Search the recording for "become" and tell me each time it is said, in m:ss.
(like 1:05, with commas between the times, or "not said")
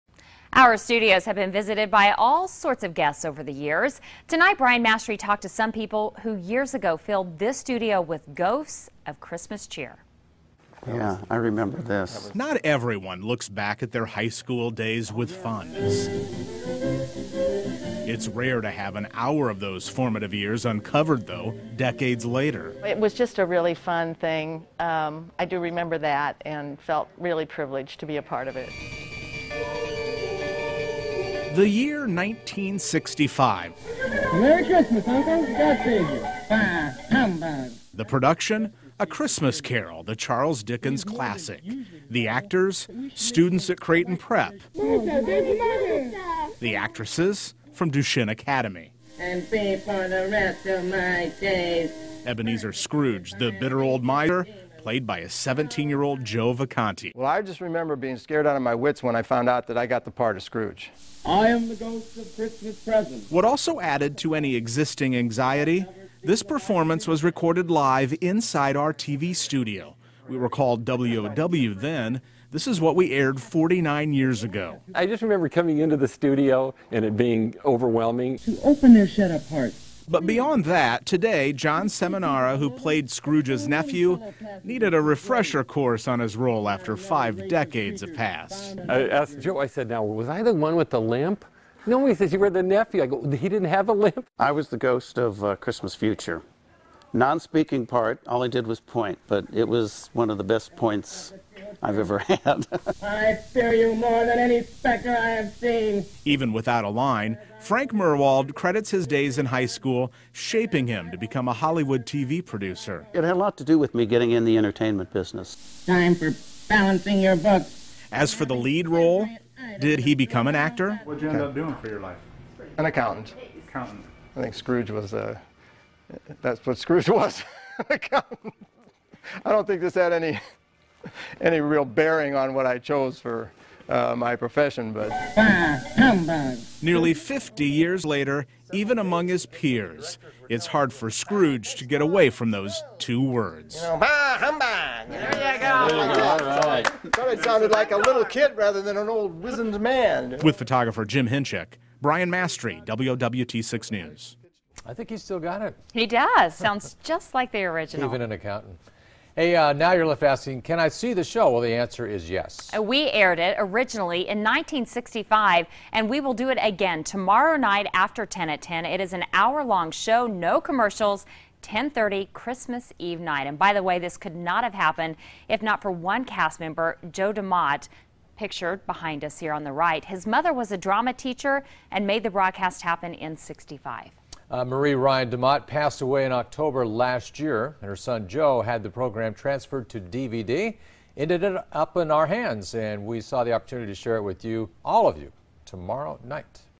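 1:51, 2:00.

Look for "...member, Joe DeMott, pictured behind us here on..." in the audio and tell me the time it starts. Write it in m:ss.
2:56.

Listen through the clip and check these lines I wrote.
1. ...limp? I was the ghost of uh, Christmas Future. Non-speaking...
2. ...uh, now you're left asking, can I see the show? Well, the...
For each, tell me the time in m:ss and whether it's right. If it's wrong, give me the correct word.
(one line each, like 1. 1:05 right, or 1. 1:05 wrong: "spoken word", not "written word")
1. 1:33 right
2. 2:39 right.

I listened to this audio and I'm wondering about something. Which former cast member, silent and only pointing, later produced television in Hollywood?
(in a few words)
Frank Murwald.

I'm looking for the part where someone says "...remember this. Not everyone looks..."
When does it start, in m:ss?
0:11.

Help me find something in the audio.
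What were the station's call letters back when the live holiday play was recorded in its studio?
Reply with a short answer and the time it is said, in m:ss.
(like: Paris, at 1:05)
WOW, at 1:10.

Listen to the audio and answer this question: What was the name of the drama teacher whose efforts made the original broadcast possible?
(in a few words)
Marie Ryan DeMott.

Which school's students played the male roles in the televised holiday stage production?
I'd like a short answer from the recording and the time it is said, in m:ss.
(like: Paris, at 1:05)
Creighton Prep, at 0:43.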